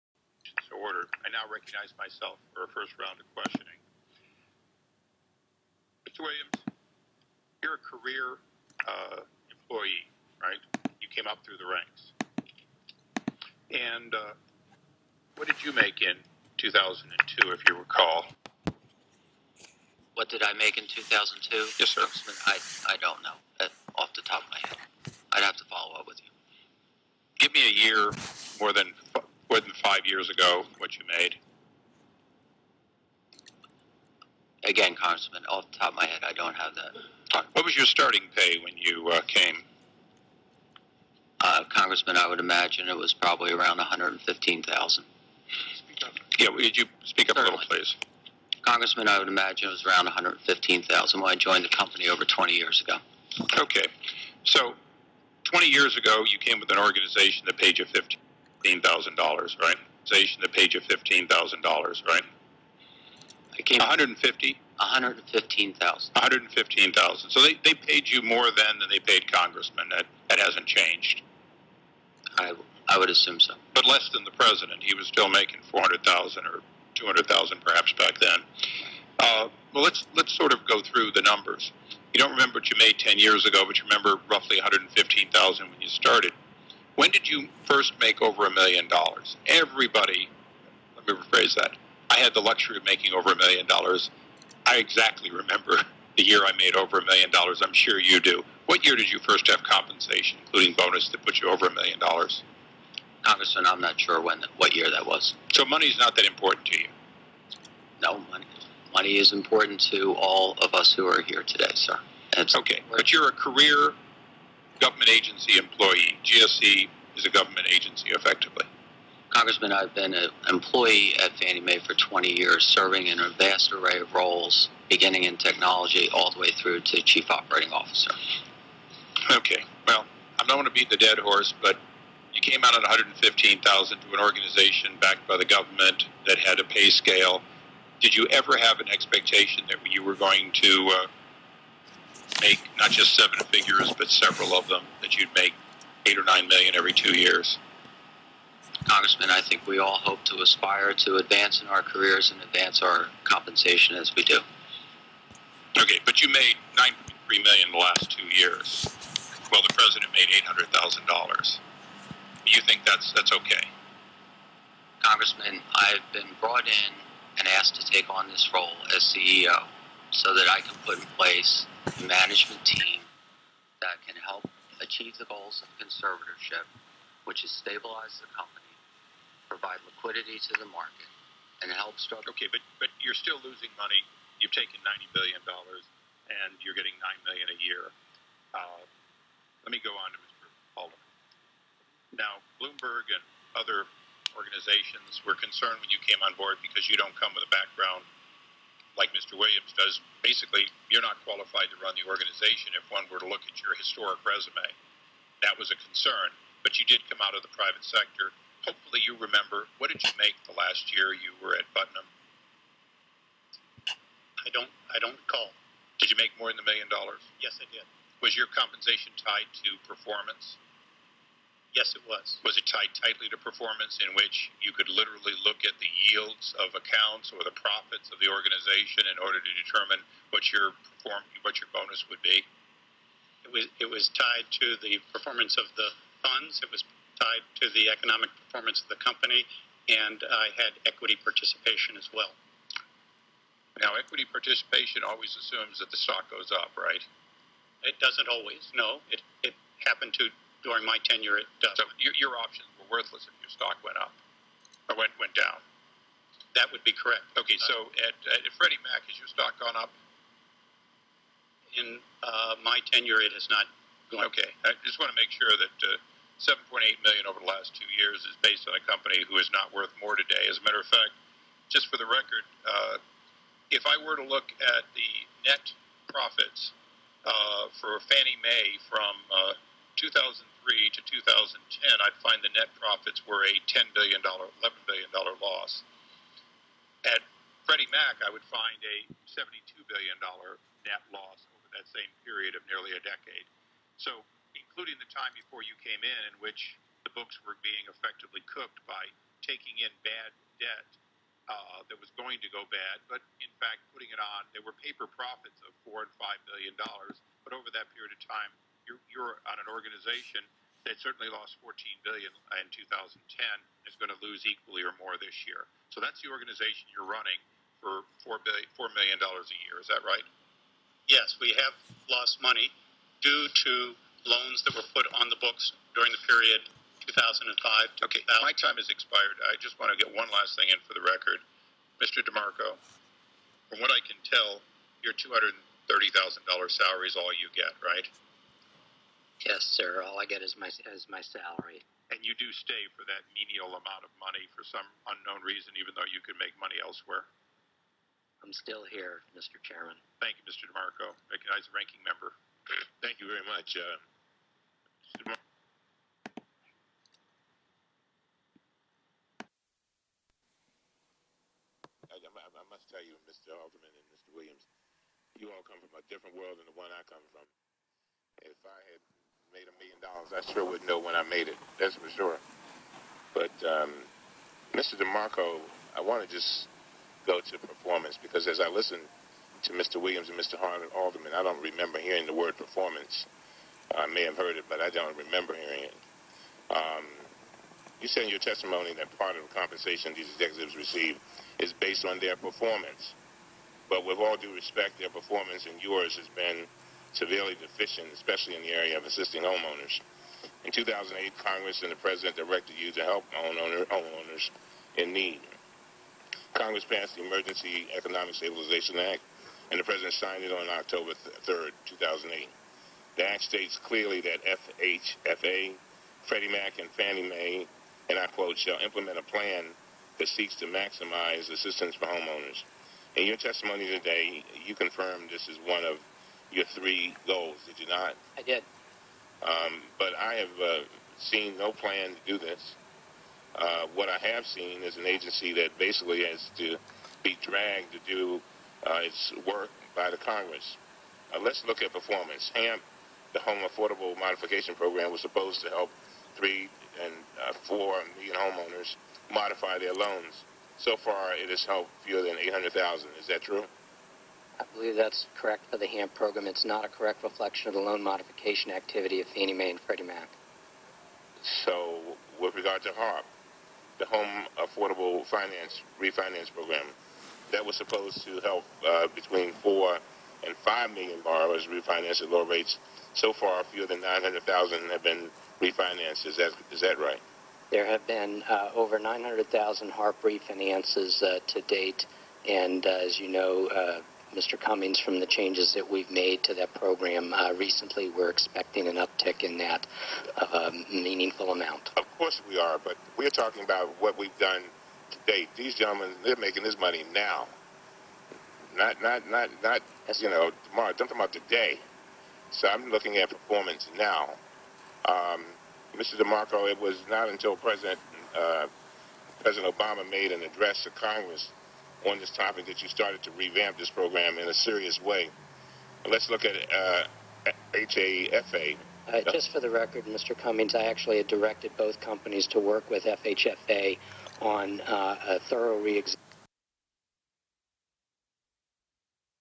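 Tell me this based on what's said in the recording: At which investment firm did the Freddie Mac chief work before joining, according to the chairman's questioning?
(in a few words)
Putnam.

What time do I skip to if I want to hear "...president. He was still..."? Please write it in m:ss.
1:14.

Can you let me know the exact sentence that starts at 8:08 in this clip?
We're expecting an uptick in that of a meaningful amount.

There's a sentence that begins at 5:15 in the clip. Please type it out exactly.
So that's the organization you're running for four billion, four million dollars a year.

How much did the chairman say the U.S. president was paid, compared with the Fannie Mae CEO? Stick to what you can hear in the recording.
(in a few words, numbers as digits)
$800,000.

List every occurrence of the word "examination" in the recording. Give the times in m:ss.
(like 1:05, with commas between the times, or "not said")
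8:45.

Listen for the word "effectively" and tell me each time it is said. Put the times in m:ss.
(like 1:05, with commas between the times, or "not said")
1:58, 4:57.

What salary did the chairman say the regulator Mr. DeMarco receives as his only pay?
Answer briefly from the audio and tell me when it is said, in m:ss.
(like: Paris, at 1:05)
$230,000, at 5:35.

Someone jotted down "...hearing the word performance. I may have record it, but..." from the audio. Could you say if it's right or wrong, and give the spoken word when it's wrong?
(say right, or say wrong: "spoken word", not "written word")
wrong: "heard", not "record".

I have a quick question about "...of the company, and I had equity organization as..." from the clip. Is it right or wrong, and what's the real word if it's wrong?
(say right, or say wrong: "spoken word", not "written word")
wrong: "participation", not "organization".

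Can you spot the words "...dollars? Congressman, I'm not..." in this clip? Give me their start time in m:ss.
1:41.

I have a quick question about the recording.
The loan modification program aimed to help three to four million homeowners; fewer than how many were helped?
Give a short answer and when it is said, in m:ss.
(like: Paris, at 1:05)
800,000, at 7:32.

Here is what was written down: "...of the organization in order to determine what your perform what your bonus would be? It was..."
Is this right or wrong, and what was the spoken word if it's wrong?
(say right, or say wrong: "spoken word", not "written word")
right.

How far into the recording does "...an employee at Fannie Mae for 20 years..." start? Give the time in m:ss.
2:00.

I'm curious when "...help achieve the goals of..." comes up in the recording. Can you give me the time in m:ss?
2:54.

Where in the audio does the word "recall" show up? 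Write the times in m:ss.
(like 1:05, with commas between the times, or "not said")
0:17, 3:35.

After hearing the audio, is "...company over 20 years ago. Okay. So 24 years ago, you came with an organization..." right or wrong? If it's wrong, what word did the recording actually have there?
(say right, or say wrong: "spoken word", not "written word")
wrong: "20", not "24".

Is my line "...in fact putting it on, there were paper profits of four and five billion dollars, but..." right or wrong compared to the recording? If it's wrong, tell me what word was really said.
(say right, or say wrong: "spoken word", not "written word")
right.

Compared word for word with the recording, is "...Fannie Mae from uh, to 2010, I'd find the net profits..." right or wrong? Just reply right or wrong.
right.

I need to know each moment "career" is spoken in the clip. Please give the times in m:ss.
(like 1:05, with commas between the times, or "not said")
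0:07, 1:53, 2:31.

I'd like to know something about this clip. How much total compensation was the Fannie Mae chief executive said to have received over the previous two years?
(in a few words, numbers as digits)
$9.3 million.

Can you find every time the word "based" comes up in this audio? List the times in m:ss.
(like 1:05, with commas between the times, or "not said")
4:28, 6:31.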